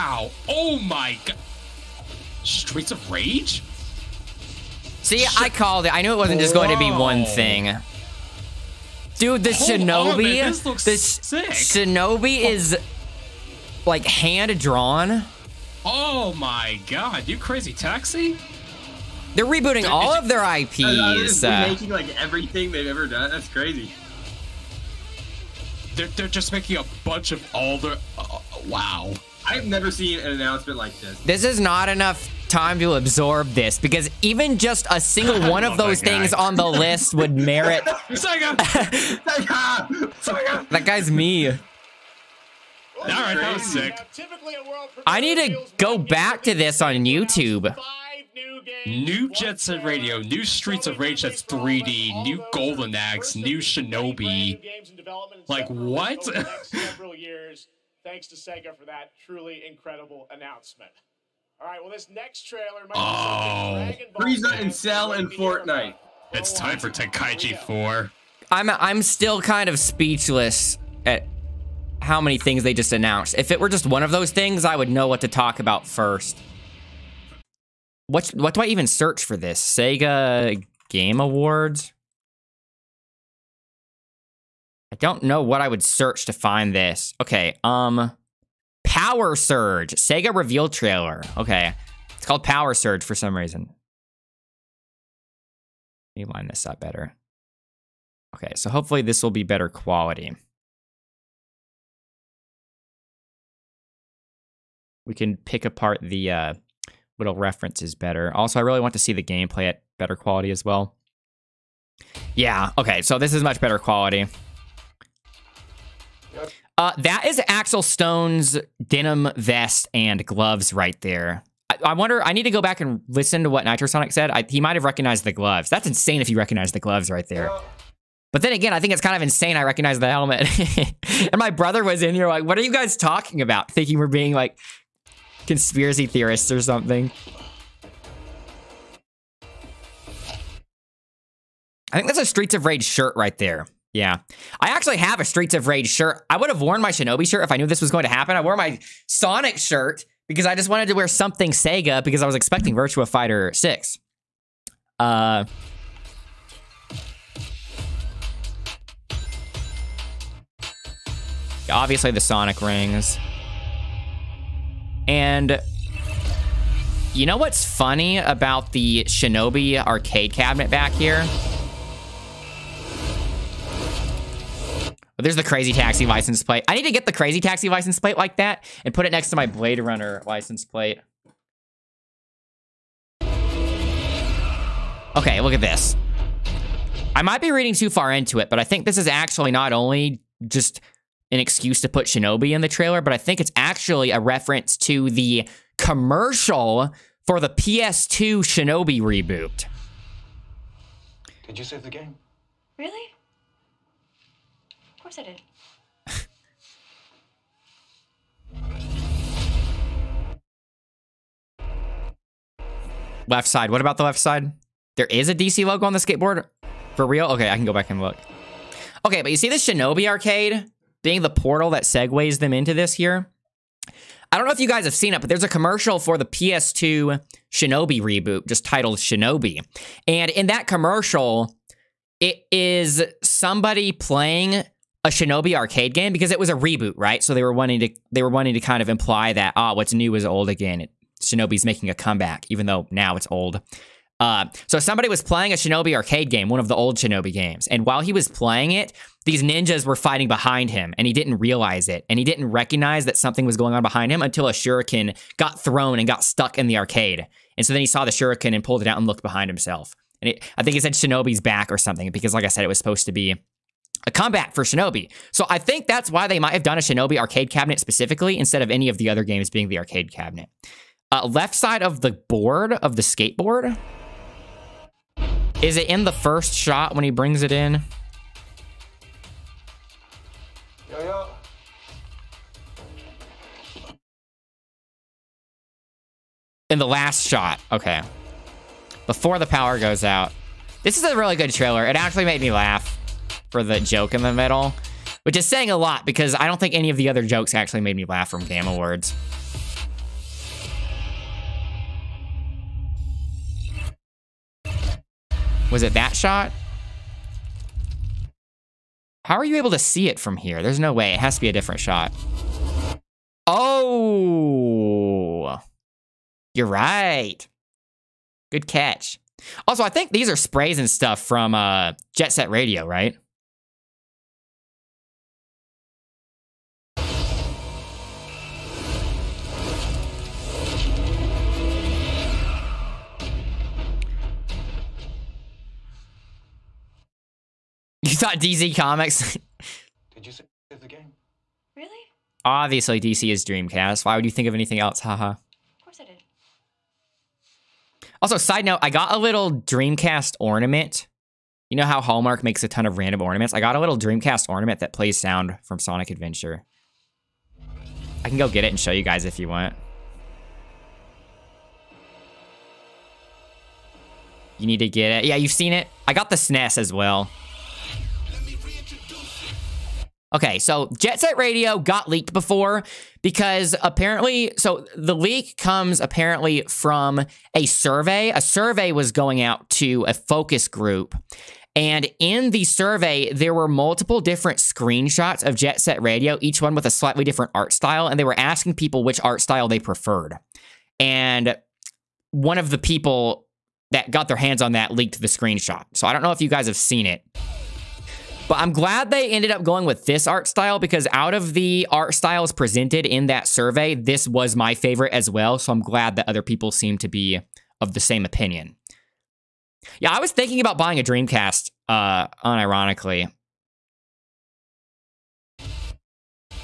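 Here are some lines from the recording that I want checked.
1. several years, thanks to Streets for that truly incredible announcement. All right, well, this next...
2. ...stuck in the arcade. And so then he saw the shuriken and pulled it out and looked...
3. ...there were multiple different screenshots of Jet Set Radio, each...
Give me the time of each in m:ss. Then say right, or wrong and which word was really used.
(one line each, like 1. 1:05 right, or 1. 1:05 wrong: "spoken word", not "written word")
1. 0:56 wrong: "Sega", not "Streets"
2. 4:16 right
3. 6:23 right.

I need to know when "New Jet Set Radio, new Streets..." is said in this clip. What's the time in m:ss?
0:48.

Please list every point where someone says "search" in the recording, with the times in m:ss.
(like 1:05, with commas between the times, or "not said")
1:18, 1:25.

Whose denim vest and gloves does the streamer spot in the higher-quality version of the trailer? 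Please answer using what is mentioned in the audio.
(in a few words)
Axel Stone.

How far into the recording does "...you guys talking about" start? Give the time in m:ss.
2:12.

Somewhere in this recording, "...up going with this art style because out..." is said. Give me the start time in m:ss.
6:39.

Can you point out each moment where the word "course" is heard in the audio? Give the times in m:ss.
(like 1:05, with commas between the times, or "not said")
3:25, 5:45.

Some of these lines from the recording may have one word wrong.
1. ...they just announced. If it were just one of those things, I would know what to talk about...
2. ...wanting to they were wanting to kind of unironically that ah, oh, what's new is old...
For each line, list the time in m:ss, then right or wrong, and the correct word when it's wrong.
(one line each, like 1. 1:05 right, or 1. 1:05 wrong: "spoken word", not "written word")
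1. 1:12 right
2. 3:57 wrong: "imply", not "unironically".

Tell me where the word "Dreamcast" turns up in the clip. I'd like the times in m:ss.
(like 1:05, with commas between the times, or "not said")
5:43, 5:49, 5:53, 6:51.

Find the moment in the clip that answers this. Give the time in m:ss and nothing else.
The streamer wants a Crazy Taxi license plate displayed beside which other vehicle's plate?
2:59.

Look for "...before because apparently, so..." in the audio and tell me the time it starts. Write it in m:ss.
6:12.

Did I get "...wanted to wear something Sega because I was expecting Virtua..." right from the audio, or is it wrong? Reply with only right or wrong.
right.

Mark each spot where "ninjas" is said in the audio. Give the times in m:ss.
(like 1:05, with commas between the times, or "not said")
4:09.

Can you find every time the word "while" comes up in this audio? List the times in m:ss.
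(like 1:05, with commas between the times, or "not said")
4:07.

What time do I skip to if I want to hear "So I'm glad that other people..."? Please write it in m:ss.
6:45.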